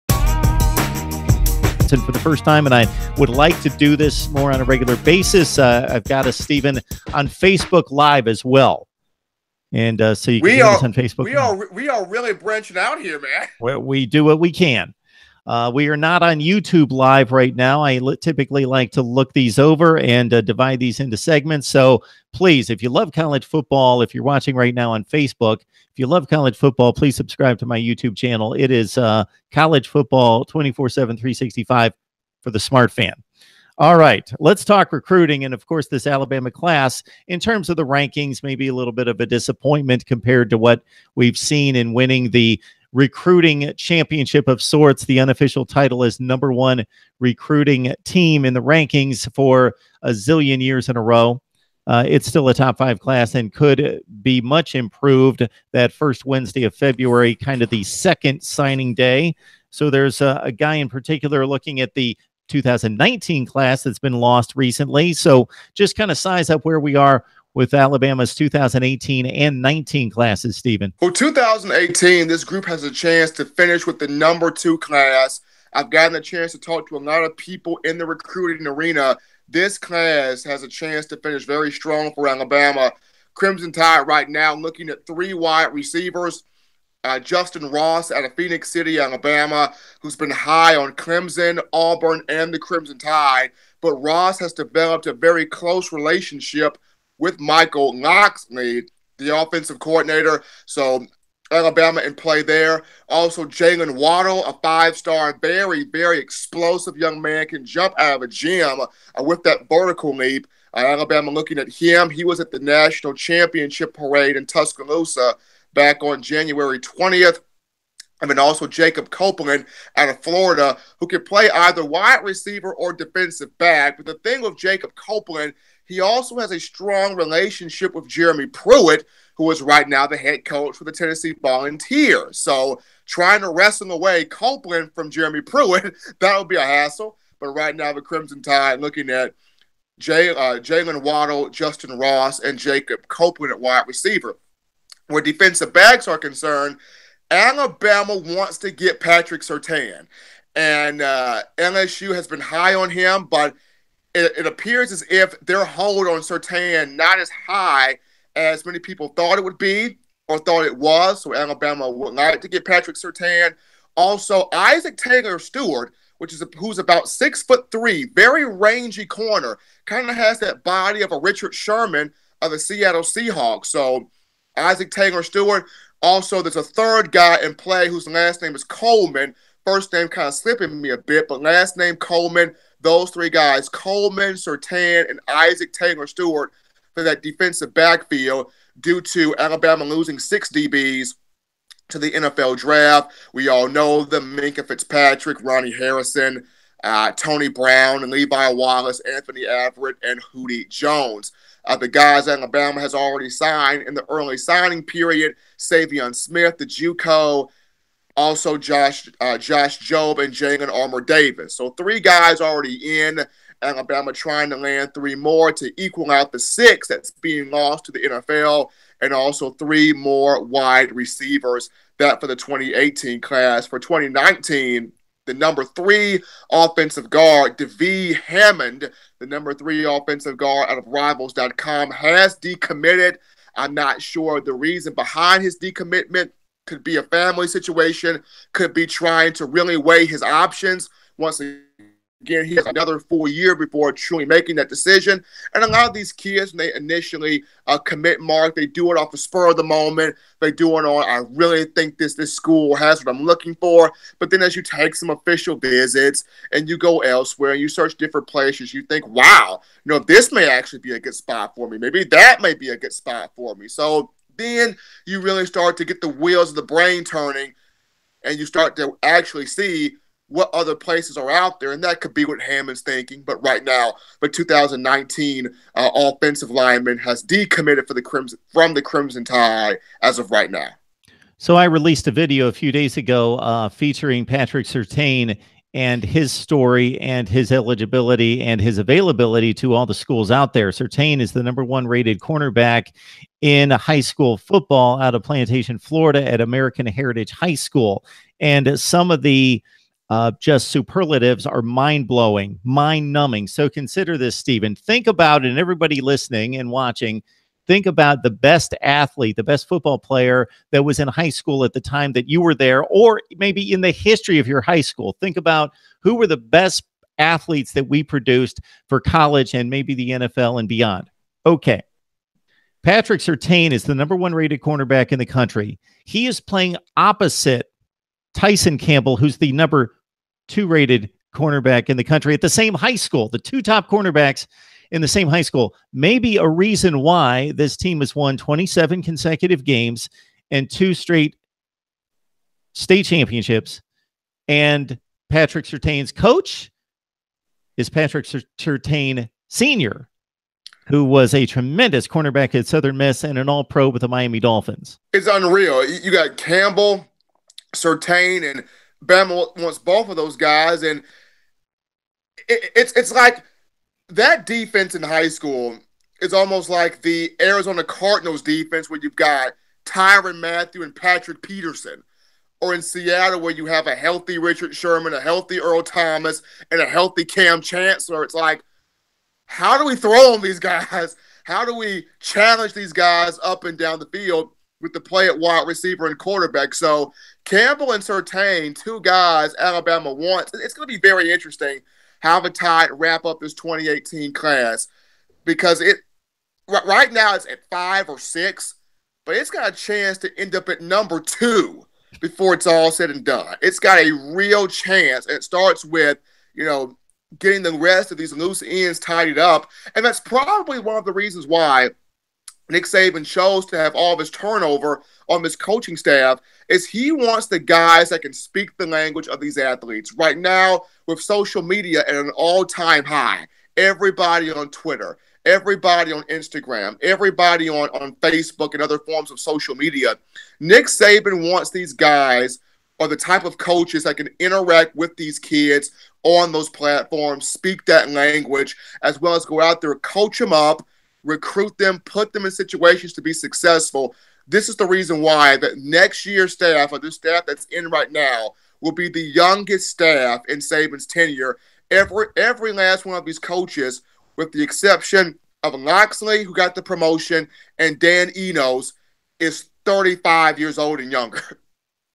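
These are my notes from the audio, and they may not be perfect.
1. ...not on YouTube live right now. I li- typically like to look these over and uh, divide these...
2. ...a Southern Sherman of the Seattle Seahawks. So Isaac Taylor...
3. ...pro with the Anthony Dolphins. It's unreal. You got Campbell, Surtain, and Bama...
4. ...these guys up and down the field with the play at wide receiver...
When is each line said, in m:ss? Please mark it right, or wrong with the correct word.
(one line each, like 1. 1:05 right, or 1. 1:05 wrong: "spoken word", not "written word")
1. 0:15 right
2. 2:51 wrong: "Richard", not "Southern"
3. 5:53 wrong: "Miami", not "Anthony"
4. 6:22 right.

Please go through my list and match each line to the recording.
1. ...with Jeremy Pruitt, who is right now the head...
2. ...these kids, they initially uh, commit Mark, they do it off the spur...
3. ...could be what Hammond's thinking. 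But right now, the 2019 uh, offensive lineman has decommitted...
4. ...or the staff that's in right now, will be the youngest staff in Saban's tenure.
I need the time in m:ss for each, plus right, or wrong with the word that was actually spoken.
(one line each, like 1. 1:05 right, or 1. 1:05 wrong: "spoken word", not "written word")
1. 2:07 right
2. 4:05 right
3. 4:32 right
4. 7:26 right.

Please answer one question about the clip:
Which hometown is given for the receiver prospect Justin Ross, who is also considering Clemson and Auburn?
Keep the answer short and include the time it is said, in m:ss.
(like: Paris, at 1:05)
Phenix City, Alabama, at 1:28.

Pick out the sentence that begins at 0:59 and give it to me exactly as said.
So there's a, a guy in particular looking at the 2019 class that's been lost recently.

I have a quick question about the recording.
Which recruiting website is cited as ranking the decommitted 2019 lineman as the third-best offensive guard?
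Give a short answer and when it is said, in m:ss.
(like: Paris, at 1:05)
rivals.com, at 3:50.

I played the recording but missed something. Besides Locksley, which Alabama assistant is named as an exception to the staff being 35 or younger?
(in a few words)
Dan Enos.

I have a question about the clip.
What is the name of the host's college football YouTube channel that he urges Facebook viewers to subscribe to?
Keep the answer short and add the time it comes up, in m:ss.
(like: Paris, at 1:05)
College Football 24 7, 365, at 0:29.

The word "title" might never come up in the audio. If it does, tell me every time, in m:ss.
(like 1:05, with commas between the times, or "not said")
0:45.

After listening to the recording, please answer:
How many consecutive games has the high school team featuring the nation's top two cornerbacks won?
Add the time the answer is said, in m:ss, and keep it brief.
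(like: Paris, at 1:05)
27, at 5:38.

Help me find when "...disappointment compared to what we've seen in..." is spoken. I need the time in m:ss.
0:39.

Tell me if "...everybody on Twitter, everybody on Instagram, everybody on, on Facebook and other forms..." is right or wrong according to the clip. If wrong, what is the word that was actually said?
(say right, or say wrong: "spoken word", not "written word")
right.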